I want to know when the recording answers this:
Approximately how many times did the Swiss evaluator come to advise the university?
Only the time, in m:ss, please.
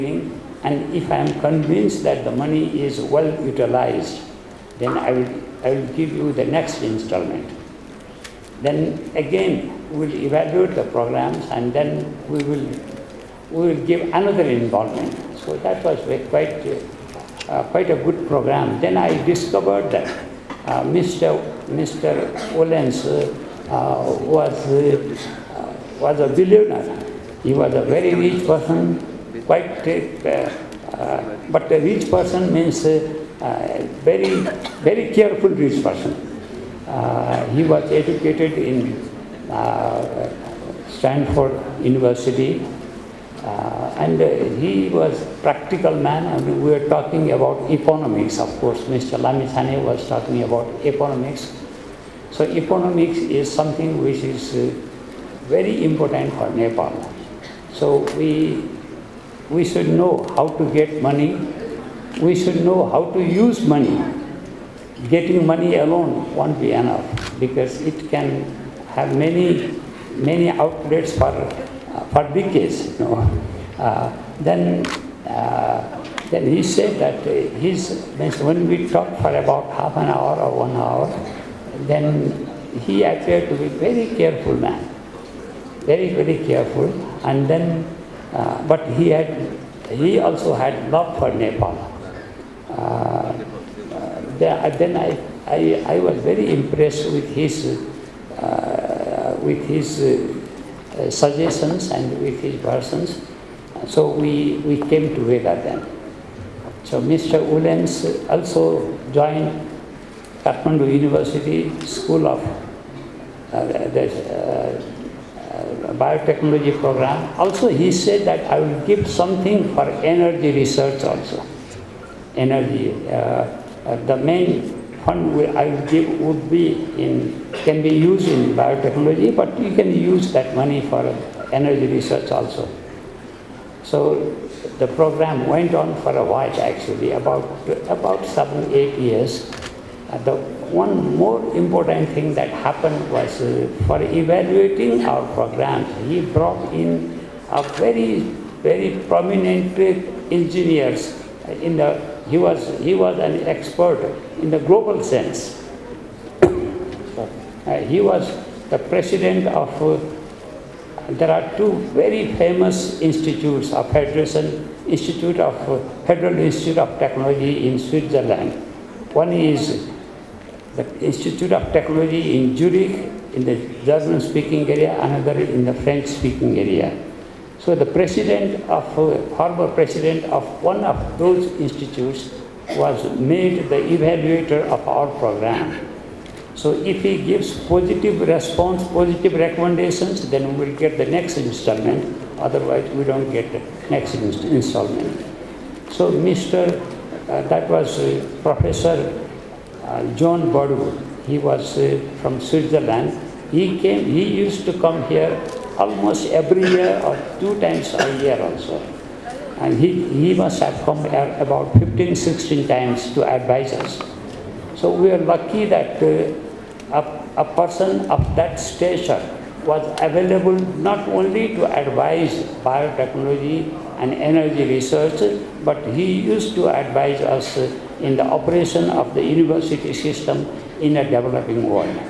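3:31.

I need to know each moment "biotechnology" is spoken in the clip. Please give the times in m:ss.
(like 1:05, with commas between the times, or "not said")
1:55, 2:08, 3:42.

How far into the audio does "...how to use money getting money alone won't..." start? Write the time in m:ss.
1:02.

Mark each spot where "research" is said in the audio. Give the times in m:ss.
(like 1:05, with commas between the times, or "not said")
2:00, 2:11, 3:44.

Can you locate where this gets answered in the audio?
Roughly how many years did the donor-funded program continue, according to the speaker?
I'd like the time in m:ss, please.
2:18.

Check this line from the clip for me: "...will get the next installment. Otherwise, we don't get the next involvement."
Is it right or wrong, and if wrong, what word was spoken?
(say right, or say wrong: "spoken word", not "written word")
wrong: "installment", not "involvement".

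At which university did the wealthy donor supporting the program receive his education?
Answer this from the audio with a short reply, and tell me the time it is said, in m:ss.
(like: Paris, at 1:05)
Stanford University, at 0:40.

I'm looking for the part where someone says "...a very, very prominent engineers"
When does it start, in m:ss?
2:27.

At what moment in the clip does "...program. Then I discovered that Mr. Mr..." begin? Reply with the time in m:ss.
0:18.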